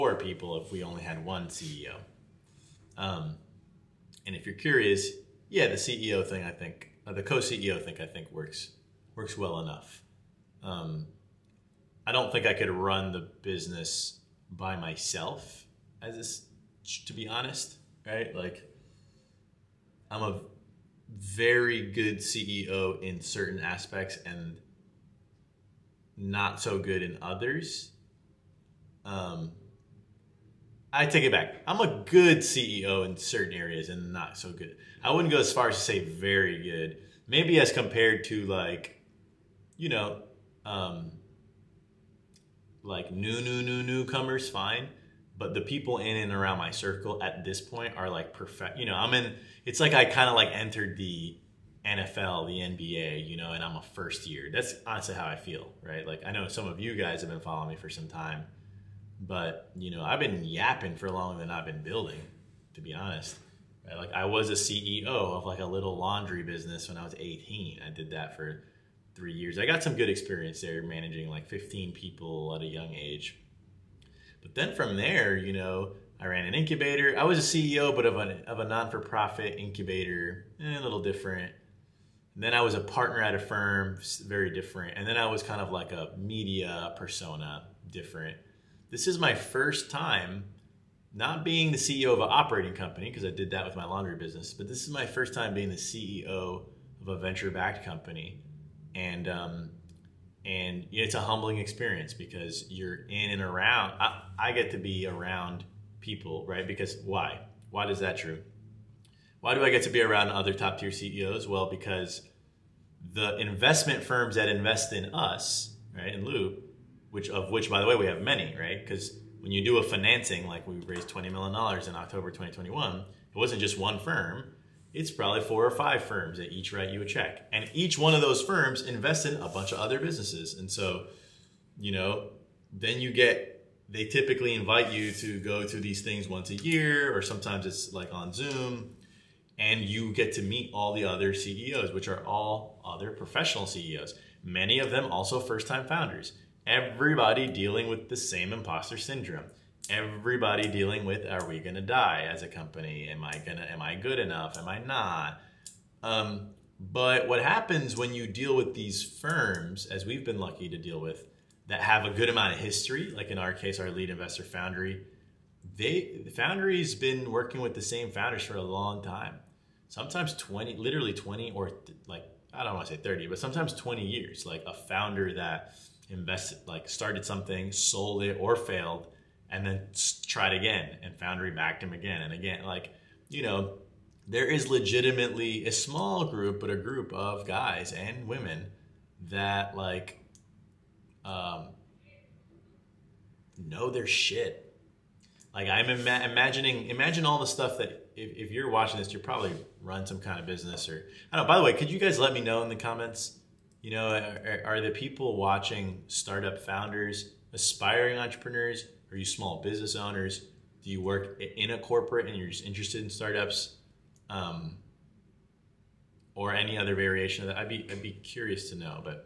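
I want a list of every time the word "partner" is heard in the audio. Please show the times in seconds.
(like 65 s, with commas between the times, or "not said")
82 s.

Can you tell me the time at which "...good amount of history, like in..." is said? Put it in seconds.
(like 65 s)
162 s.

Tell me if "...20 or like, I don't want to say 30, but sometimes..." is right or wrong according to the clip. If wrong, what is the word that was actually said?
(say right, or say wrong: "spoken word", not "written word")
right.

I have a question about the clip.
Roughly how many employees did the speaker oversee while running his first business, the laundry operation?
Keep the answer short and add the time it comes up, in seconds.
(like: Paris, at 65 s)
15, at 71 s.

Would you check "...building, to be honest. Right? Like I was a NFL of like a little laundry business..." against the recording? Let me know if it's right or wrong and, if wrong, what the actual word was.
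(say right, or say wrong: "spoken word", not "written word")
wrong: "CEO", not "NFL".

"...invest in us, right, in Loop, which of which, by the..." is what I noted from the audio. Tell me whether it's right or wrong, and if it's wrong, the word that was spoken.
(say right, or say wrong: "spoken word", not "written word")
right.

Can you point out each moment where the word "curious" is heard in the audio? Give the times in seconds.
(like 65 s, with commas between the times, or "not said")
4 s, 218 s.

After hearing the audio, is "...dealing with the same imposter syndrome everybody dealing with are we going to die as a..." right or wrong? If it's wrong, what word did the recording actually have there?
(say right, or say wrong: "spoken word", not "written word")
right.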